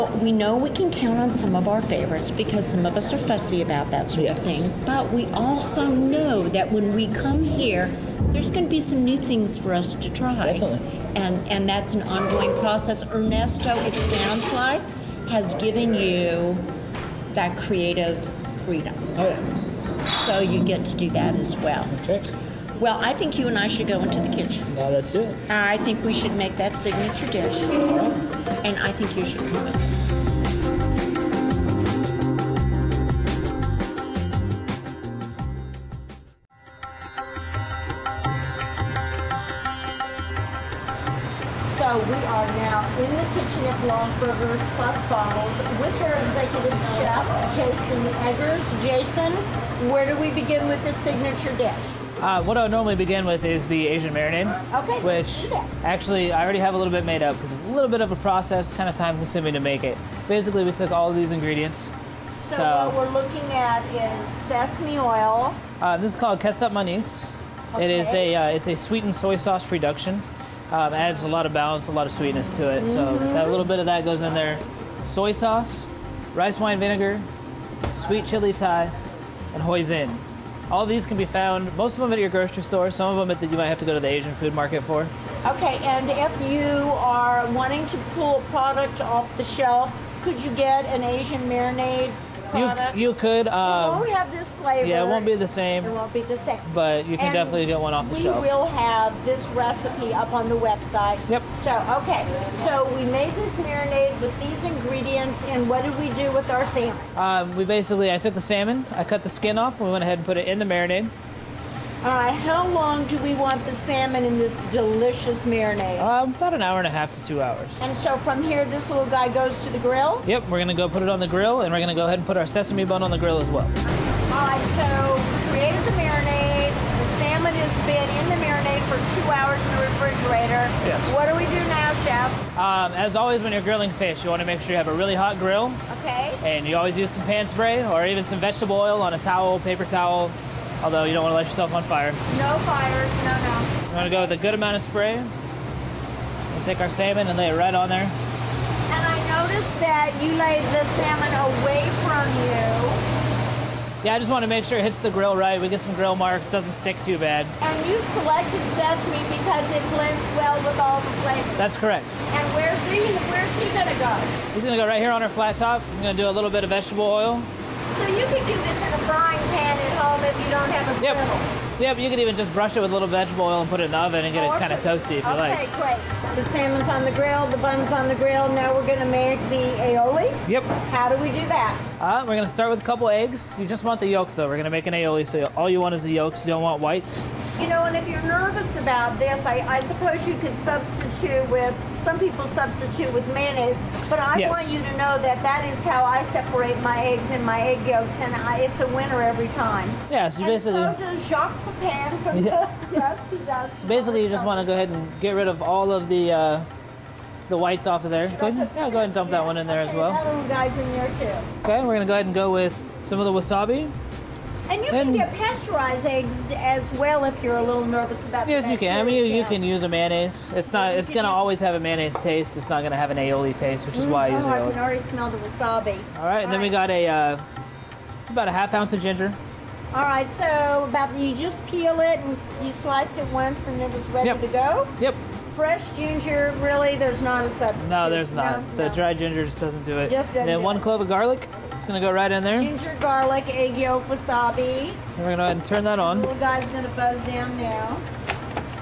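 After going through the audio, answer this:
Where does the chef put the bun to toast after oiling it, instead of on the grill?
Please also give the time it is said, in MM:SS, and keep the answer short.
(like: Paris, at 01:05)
Flat top, at 02:45.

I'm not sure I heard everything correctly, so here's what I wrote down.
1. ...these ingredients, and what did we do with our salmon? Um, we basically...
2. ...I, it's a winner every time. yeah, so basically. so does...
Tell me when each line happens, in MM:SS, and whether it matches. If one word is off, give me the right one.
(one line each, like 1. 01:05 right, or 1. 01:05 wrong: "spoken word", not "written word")
1. 01:44 right
2. 03:18 right.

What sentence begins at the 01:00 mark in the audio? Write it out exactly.
Basically, we took all of these ingredients.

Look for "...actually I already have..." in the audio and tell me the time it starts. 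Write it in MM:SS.
00:55.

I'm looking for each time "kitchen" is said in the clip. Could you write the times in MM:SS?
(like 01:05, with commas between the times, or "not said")
00:24, 00:43.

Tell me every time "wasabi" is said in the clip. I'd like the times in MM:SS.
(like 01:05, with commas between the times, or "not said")
03:33, 03:45, 04:04.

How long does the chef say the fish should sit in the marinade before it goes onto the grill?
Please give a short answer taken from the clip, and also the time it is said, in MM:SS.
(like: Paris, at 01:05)
1.5 to 2 hours, at 01:56.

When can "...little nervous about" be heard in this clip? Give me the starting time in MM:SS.
03:37.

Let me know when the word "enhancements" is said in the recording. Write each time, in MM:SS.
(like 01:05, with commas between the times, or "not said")
not said.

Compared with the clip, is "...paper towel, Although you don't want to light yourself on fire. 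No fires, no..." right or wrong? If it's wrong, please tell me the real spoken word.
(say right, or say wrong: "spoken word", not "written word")
right.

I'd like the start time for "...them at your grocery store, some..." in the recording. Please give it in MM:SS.
01:22.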